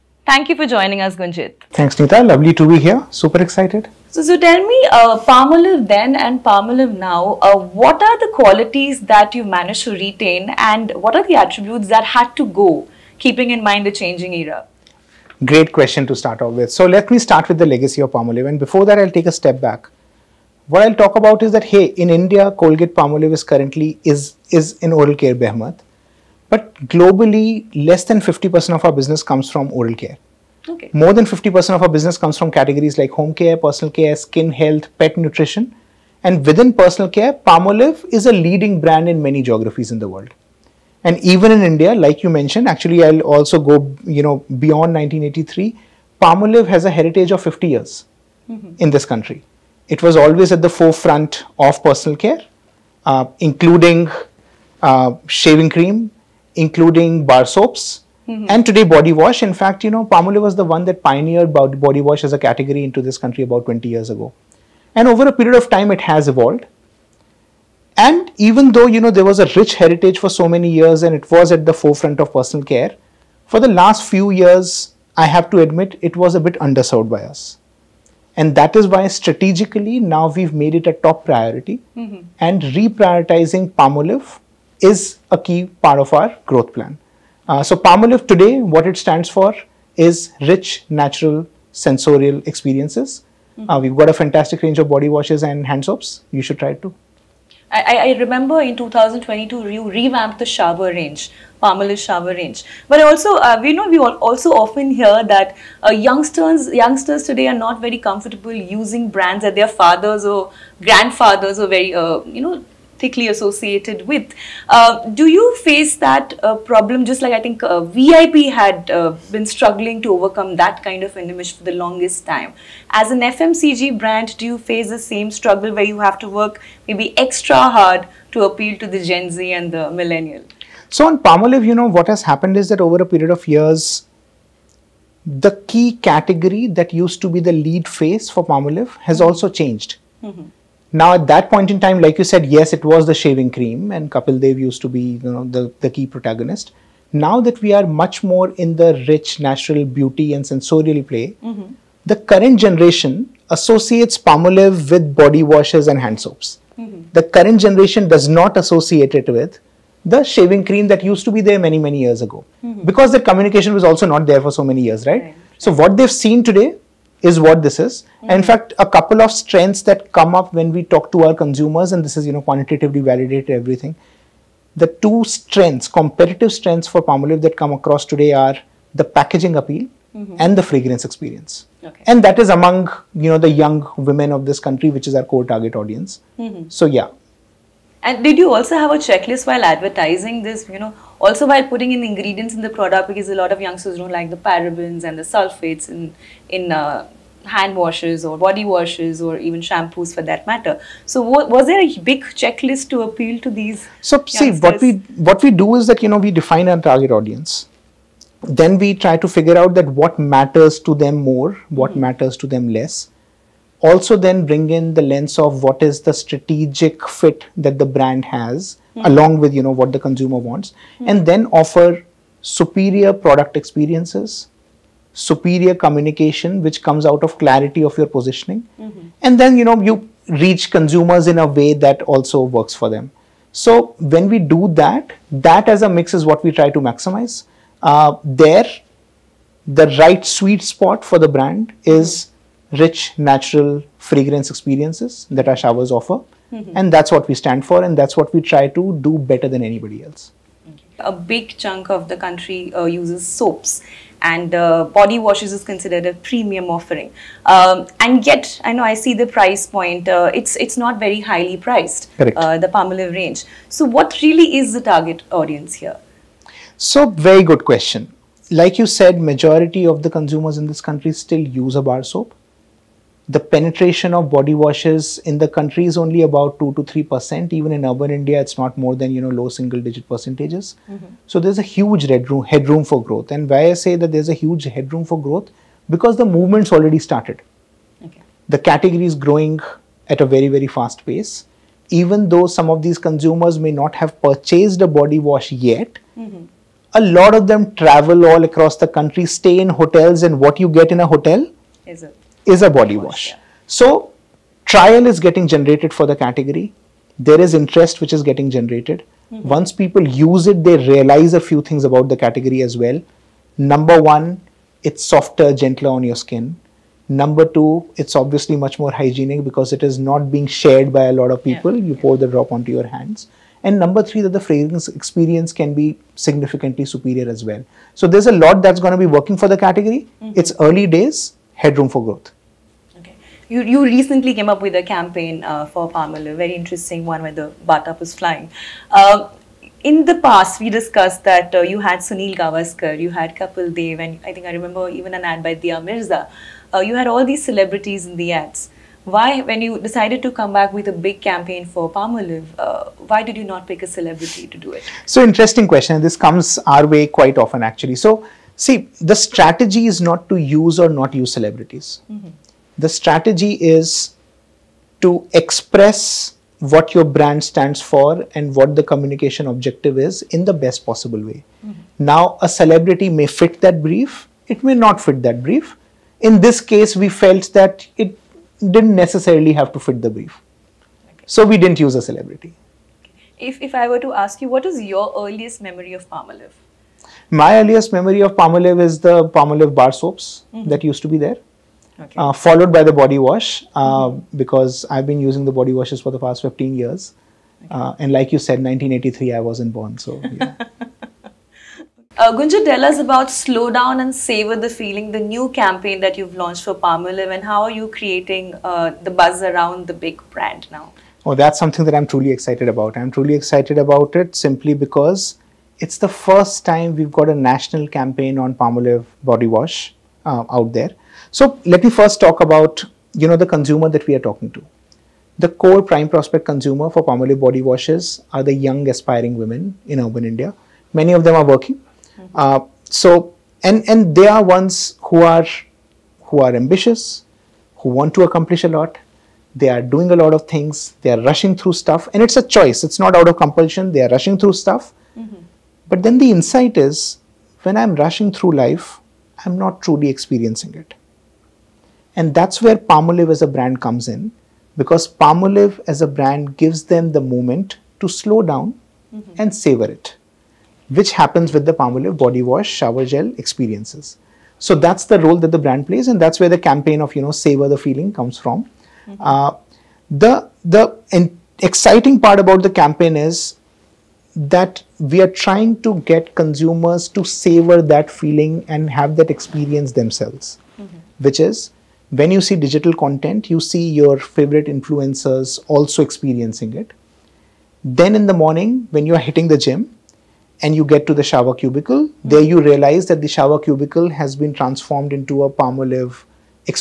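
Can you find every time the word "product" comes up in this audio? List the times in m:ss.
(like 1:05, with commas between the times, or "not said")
3:12, 3:43.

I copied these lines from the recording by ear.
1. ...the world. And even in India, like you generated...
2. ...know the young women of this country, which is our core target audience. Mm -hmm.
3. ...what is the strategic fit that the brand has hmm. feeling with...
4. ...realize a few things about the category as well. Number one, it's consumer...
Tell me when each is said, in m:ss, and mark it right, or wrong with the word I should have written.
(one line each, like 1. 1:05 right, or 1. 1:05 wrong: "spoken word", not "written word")
1. 0:39 wrong: "mentioned", not "generated"
2. 3:03 right
3. 3:35 wrong: "along", not "feeling"
4. 5:10 wrong: "softer", not "consumer".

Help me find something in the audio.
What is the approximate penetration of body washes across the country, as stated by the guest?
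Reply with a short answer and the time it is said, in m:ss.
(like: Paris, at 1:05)
2 to 3 percent, at 4:36.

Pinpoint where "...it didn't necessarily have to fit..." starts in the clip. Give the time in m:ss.
6:18.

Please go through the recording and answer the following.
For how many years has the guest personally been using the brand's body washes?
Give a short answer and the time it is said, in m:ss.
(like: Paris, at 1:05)
15 years, at 6:36.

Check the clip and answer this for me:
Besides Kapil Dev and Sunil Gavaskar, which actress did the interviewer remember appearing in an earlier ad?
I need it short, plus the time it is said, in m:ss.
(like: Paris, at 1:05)
Dia Mirza, at 5:45.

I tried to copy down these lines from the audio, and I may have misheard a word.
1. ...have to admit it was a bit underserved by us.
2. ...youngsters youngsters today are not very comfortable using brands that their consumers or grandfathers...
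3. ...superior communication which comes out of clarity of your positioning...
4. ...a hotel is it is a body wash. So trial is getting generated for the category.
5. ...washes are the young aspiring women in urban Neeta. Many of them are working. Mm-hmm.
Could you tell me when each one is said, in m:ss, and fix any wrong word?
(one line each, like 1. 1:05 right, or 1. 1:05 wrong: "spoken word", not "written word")
1. 1:15 right
2. 1:45 wrong: "fathers", not "consumers"
3. 3:45 right
4. 5:01 right
5. 7:07 wrong: "India", not "Neeta".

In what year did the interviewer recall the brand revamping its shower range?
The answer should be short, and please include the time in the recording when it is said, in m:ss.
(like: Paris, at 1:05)
2022, at 1:38.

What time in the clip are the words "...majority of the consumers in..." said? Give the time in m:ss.
4:29.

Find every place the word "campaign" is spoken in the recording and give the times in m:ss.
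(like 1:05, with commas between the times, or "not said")
5:34, 5:51, 6:45, 6:57, 7:46, 7:52.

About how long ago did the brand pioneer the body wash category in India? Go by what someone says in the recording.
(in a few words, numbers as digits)
20 years ago.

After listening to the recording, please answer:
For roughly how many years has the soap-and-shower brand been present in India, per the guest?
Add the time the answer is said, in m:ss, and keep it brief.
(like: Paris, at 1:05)
50 years, at 0:47.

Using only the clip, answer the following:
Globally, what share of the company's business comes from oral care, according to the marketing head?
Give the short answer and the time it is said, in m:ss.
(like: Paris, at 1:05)
less than 50%, at 0:27.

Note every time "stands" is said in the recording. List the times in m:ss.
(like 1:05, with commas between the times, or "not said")
1:28, 4:07, 6:07.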